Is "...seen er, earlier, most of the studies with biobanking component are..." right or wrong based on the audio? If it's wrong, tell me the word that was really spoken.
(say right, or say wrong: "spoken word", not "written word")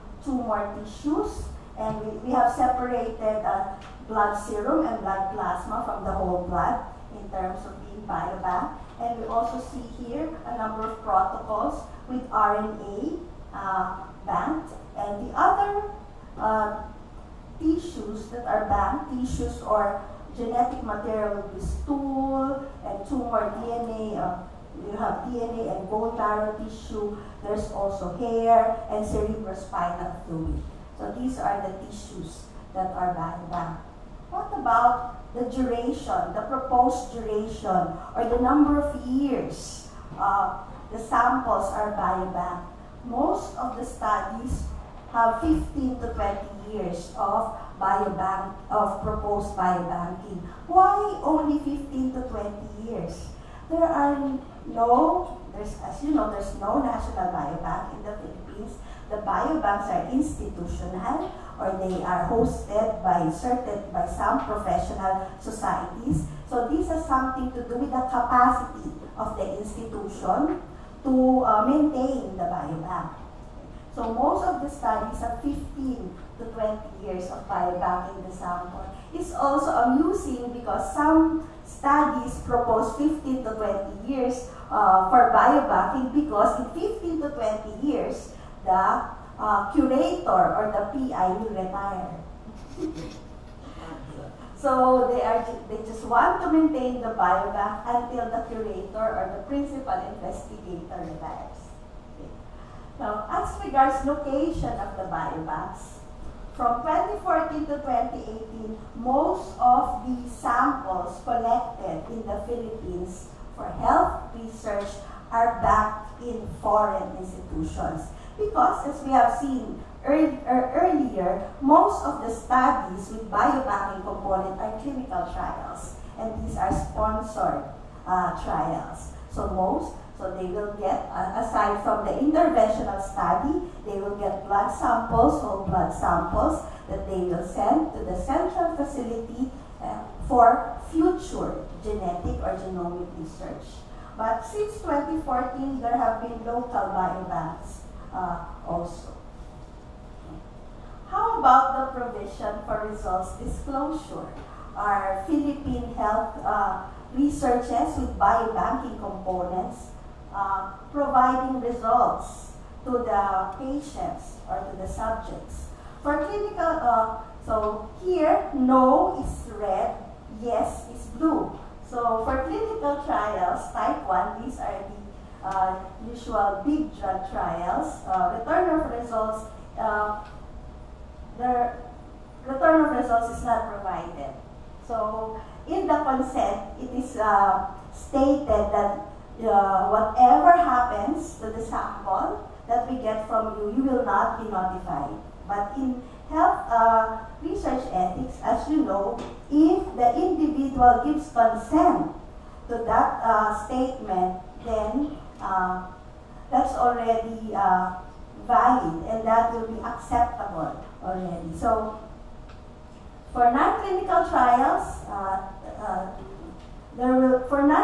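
right.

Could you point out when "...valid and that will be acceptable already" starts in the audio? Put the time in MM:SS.
03:28.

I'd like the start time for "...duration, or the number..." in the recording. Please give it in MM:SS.
00:37.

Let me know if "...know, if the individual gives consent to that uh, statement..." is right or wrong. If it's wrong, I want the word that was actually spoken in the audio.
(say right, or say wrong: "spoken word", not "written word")
right.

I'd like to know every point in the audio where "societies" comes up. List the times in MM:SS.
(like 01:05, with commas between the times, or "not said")
01:05.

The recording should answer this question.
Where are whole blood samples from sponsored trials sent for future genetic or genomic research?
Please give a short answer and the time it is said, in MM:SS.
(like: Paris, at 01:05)
Central facility, at 02:18.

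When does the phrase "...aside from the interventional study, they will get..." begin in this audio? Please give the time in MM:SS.
02:11.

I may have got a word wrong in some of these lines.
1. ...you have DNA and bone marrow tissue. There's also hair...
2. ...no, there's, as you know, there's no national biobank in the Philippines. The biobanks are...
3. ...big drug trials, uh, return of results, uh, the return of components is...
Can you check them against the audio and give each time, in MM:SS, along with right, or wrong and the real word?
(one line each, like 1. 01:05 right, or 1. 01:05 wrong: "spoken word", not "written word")
1. 00:24 right
2. 00:54 right
3. 02:56 wrong: "results", not "components".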